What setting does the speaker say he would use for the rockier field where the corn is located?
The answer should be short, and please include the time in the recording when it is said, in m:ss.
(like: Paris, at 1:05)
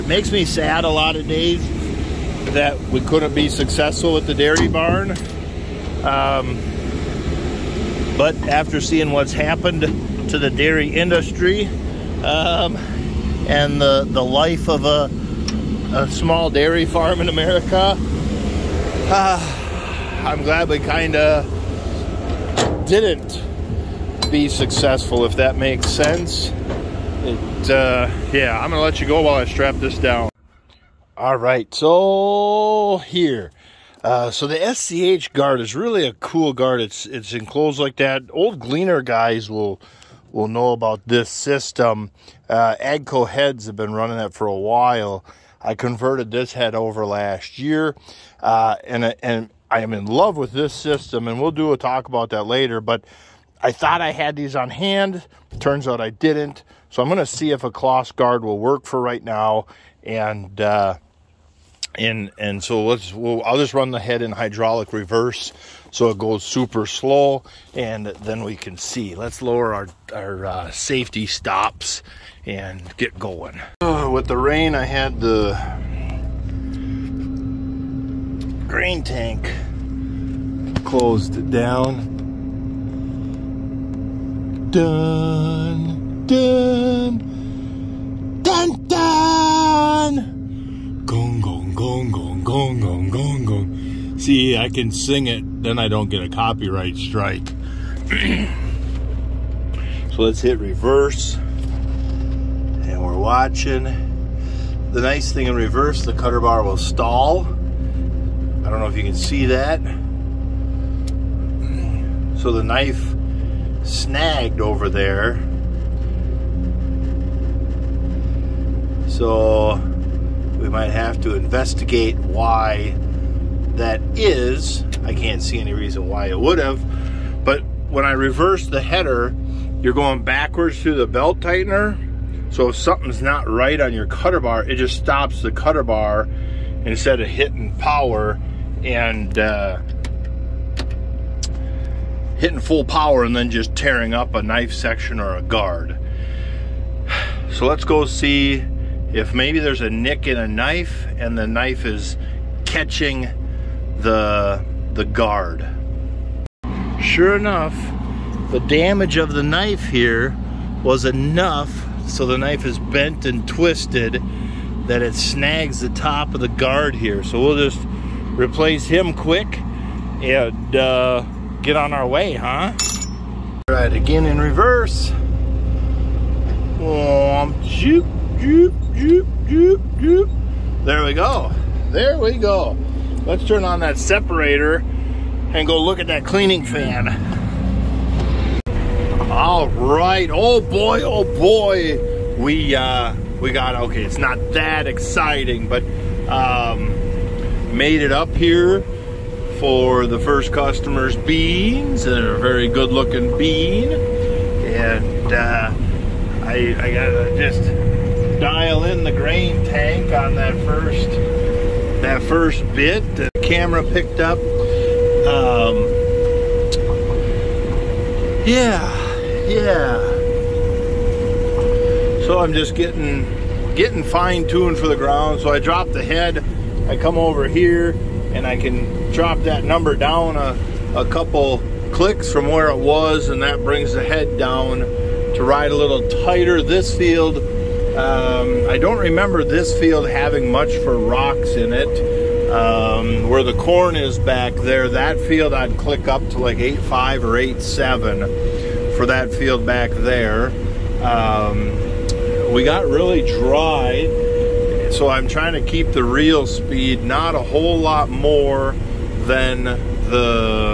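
8.5 or 8.7, at 4:06.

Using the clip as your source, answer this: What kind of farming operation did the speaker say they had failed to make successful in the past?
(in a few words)
Dairy barn.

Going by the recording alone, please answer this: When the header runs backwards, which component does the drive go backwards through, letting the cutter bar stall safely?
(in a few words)
Belt tightener.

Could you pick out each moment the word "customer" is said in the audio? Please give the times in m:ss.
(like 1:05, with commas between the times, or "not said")
3:20.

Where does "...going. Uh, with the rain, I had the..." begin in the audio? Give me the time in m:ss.
1:13.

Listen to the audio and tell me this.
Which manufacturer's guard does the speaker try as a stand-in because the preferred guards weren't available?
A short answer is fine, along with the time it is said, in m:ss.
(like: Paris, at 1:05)
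Claas, at 0:57.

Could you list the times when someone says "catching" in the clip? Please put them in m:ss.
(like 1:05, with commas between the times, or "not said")
2:32.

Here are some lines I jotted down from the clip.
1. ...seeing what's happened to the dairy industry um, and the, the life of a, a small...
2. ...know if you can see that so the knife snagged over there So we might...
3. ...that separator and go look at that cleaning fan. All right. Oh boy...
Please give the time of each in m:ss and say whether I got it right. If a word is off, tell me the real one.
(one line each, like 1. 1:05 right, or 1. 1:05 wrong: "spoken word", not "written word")
1. 0:08 right
2. 1:48 right
3. 3:03 right.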